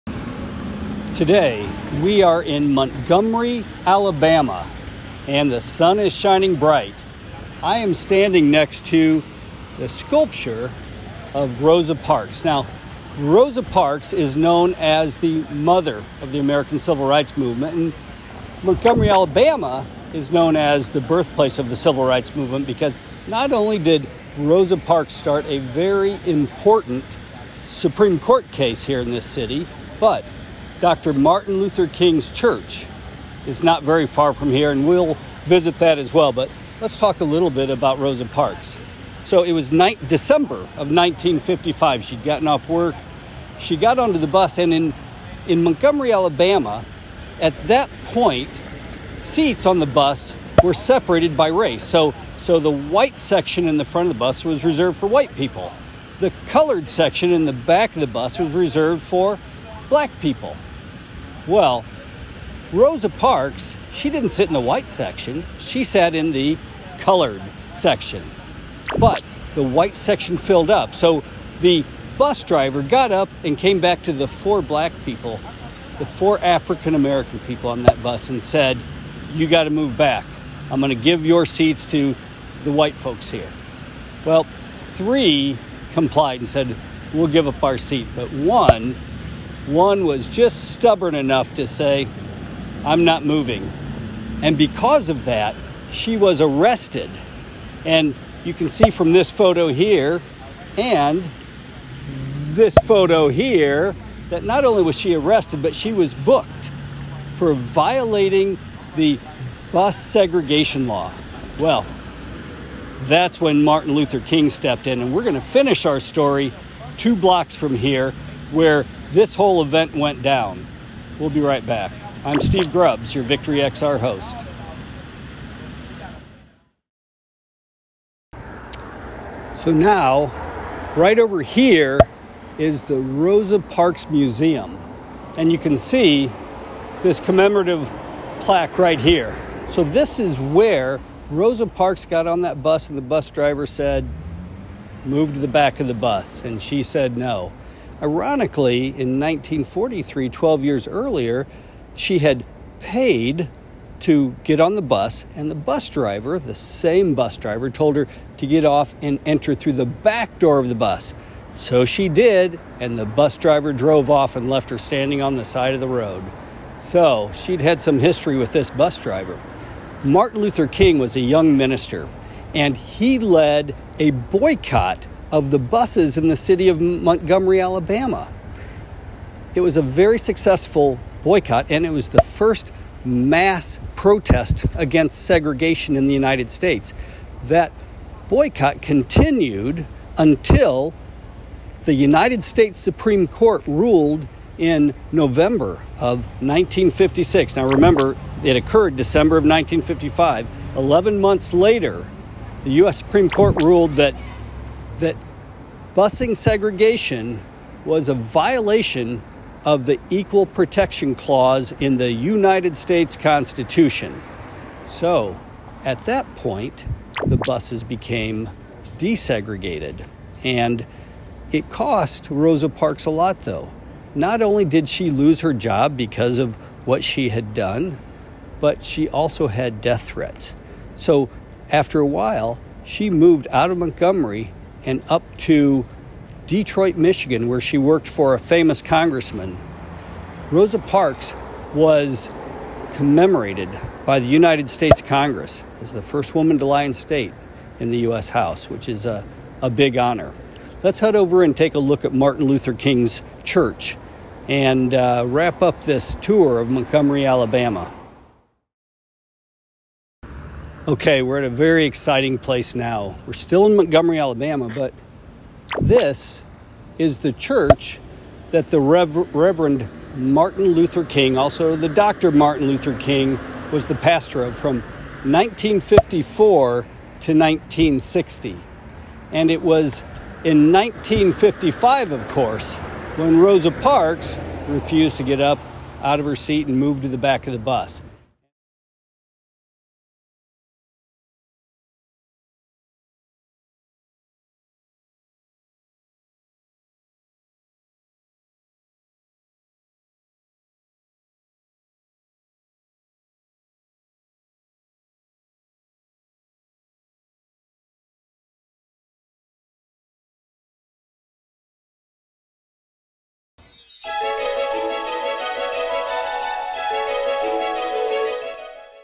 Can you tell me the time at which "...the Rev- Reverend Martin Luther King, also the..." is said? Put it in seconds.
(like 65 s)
268 s.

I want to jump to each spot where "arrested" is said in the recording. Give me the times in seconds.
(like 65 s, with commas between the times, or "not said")
96 s, 105 s.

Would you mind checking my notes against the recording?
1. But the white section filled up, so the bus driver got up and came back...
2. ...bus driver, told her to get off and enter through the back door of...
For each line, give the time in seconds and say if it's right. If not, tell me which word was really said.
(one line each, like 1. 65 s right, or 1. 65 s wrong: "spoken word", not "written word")
1. 68 s right
2. 157 s right.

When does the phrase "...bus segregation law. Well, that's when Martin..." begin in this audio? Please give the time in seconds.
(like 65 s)
109 s.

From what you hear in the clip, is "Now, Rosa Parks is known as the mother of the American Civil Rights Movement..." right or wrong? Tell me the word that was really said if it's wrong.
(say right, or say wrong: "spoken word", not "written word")
right.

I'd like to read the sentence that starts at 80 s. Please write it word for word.
I'm going to give your seats to the white folks here.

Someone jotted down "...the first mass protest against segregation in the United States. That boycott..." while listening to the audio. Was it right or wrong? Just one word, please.
right.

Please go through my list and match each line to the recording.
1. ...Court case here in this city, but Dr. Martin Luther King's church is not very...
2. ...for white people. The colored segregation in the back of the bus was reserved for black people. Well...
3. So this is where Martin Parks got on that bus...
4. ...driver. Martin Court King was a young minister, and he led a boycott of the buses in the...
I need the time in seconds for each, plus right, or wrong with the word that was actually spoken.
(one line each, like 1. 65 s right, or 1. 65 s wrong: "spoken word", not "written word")
1. 28 s right
2. 54 s wrong: "section", not "segregation"
3. 139 s wrong: "Rosa", not "Martin"
4. 168 s wrong: "Luther", not "Court".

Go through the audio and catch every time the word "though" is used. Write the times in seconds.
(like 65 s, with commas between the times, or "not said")
223 s.